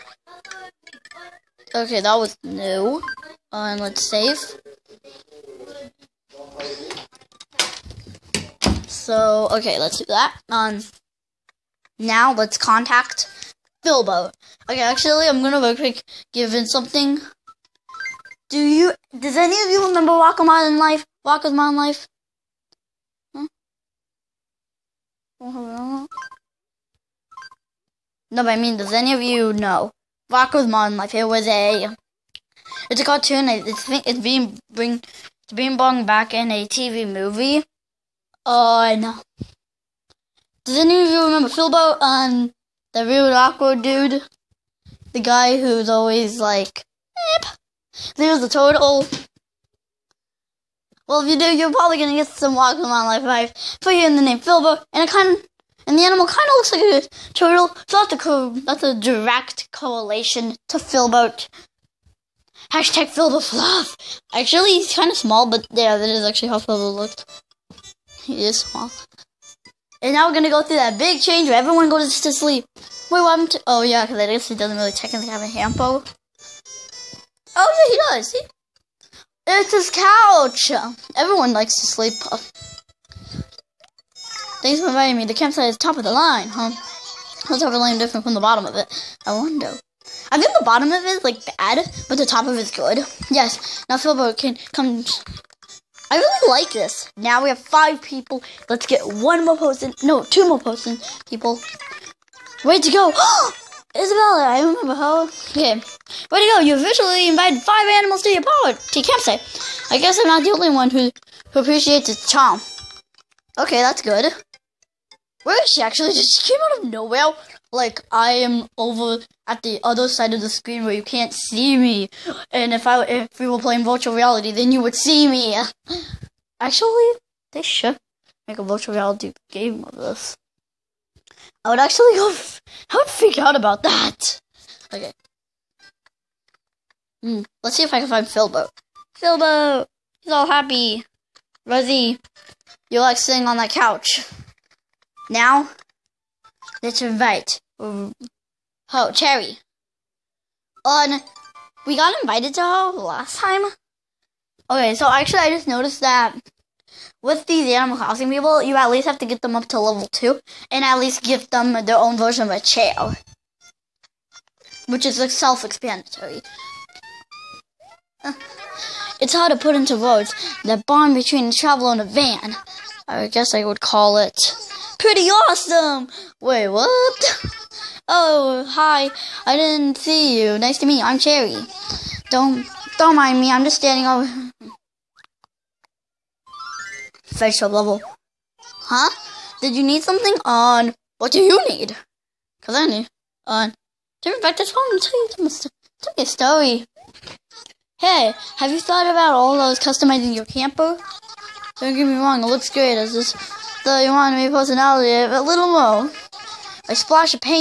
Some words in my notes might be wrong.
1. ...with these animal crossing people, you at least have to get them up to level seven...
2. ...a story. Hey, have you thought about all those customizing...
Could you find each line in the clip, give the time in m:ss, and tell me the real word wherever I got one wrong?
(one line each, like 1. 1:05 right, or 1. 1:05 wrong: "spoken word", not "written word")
1. 2:37 wrong: "two", not "seven"
2. 3:16 right.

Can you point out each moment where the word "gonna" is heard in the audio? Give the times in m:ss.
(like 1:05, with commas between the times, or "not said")
0:15, 0:51, 1:10.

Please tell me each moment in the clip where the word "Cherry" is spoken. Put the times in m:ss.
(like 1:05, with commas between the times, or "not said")
2:29, 3:01.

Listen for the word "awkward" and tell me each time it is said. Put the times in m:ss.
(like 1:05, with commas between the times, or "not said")
0:43.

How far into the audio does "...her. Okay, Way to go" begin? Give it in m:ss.
1:44.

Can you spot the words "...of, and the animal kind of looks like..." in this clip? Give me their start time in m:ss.
0:55.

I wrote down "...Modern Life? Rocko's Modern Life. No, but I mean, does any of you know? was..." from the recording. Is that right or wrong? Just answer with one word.
right.